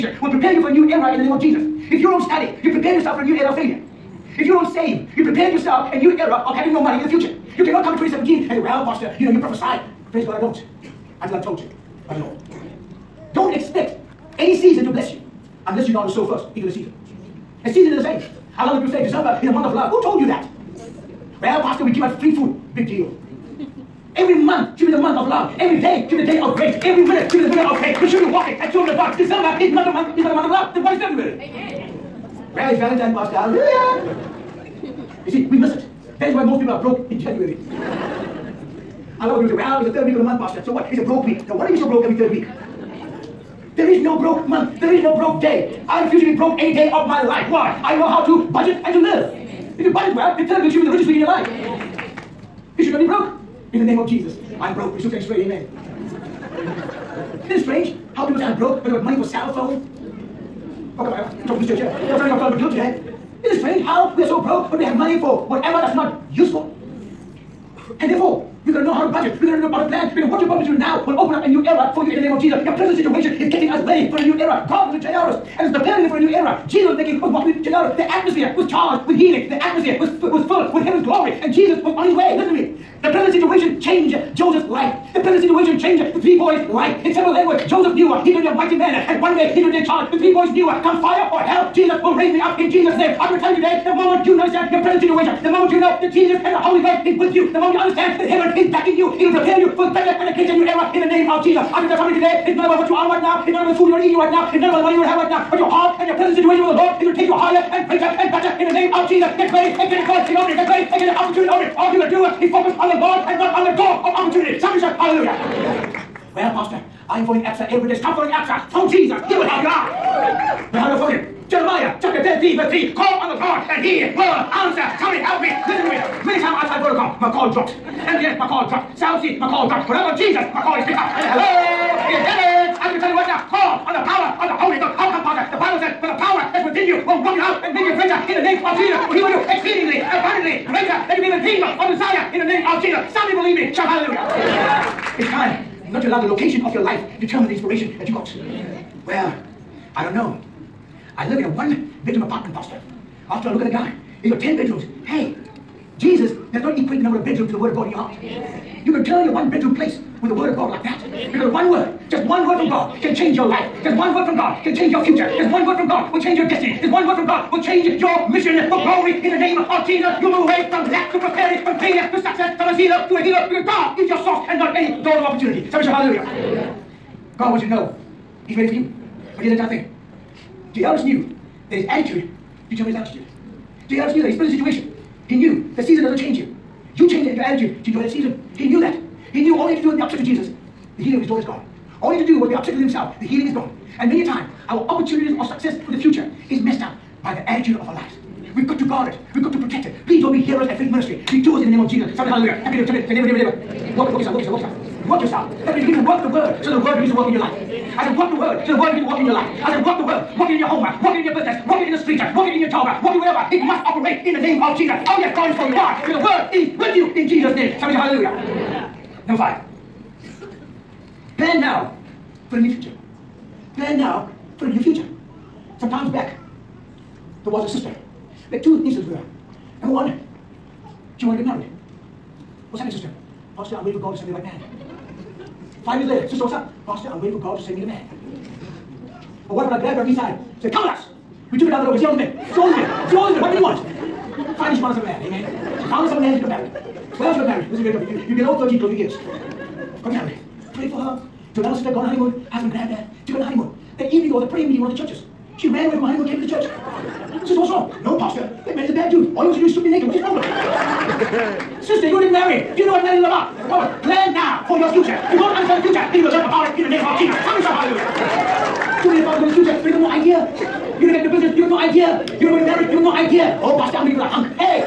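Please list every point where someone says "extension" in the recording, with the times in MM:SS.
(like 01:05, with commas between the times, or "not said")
not said.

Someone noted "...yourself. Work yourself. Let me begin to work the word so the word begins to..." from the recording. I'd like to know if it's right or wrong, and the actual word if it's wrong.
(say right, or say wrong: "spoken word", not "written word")
right.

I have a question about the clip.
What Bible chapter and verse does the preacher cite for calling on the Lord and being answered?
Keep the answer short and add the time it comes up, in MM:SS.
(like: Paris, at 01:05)
Jeremiah 13:3, at 02:01.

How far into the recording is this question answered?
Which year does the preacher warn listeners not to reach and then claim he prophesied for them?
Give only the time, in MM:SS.
00:07.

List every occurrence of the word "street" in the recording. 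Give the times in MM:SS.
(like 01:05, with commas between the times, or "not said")
03:32.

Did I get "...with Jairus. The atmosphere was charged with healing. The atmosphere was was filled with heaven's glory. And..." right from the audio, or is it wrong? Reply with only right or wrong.
right.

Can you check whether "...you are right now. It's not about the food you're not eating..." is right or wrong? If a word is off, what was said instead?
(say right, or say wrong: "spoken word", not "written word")
right.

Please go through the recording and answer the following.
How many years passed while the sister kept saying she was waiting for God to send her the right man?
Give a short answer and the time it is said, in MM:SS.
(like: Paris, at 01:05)
5, at 03:55.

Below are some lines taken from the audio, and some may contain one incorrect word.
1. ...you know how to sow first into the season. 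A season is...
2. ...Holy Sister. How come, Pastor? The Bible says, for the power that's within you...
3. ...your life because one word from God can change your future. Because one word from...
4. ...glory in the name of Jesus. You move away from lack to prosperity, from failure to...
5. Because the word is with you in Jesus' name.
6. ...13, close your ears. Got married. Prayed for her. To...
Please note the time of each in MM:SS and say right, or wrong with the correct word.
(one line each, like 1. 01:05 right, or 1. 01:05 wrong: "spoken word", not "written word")
1. 00:15 right
2. 02:14 wrong: "Ghost", not "Sister"
3. 02:43 right
4. 02:48 right
5. 03:36 right
6. 04:08 right.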